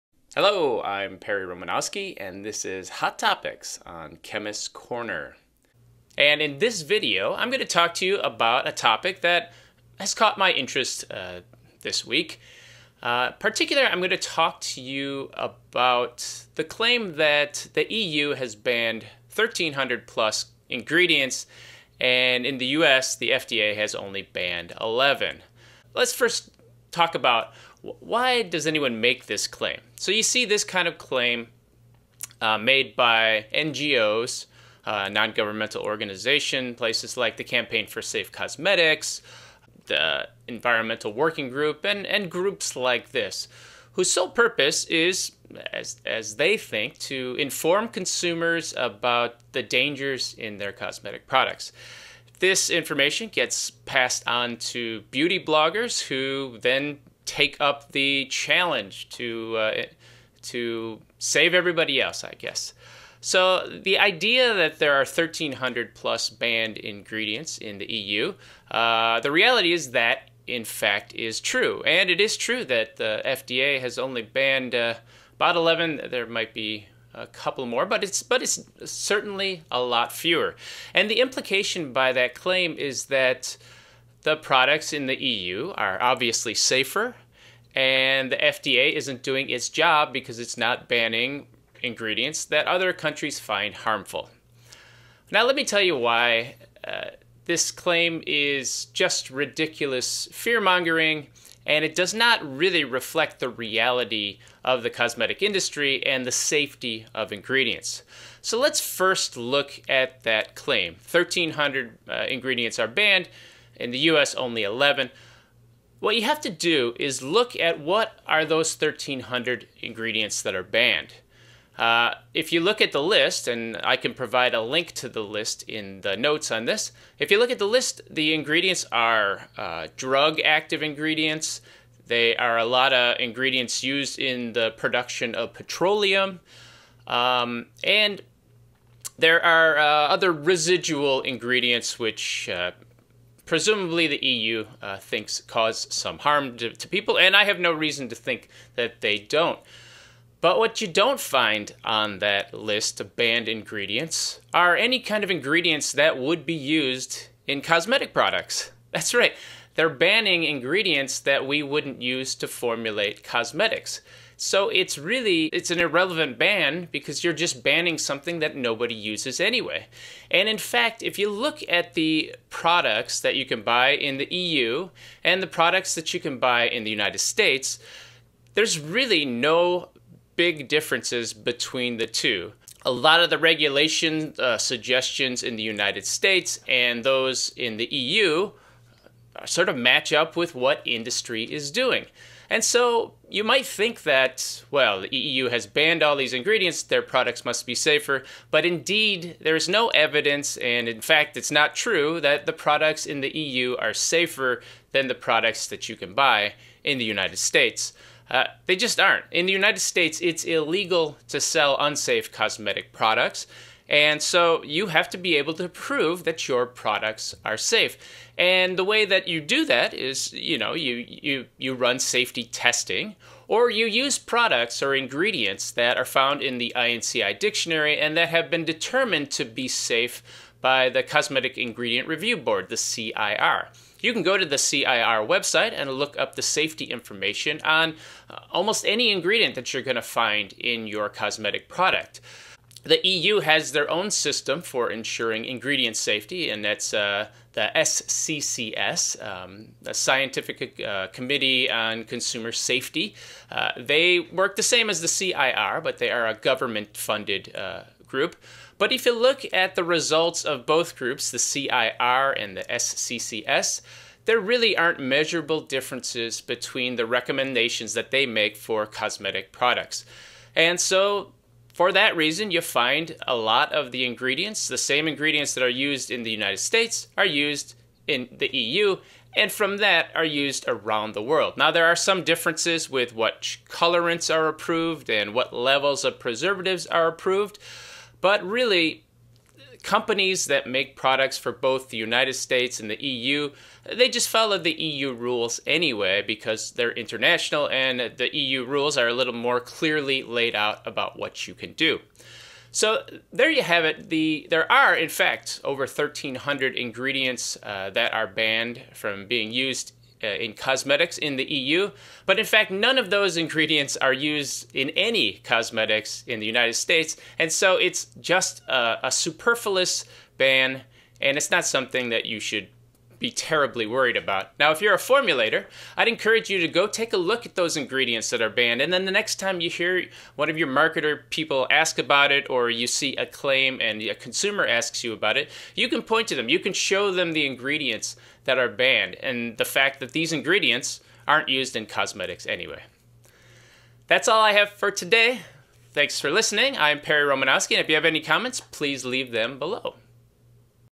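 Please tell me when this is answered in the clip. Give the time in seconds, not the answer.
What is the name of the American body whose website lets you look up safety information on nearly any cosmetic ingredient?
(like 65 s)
231 s.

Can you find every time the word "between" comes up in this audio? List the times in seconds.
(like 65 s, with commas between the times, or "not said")
181 s, 266 s.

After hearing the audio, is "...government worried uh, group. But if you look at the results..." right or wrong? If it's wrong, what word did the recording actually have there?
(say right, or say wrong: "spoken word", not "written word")
wrong: "funded", not "worried".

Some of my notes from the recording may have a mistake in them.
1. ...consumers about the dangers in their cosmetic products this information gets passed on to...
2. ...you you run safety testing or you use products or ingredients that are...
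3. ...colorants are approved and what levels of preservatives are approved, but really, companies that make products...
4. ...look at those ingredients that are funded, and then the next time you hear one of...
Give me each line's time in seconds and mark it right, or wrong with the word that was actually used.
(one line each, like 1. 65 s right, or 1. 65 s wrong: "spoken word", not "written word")
1. 47 s right
2. 221 s right
3. 283 s right
4. 327 s wrong: "banned", not "funded".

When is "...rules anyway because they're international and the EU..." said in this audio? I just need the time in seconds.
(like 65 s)
295 s.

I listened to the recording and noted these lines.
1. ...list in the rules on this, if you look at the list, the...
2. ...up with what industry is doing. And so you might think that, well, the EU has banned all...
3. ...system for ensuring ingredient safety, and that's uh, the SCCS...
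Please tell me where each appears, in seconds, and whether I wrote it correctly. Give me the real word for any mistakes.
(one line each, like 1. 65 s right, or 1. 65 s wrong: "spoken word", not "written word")
1. 125 s wrong: "notes", not "rules"
2. 190 s right
3. 244 s right.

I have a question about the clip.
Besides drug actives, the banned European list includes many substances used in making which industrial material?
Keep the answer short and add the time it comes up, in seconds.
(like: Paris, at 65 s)
petroleum, at 135 s.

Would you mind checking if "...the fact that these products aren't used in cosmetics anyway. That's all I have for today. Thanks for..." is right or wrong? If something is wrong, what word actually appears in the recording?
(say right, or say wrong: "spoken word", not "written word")
wrong: "ingredients", not "products".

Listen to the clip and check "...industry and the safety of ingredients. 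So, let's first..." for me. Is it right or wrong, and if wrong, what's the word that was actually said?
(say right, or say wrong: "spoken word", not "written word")
right.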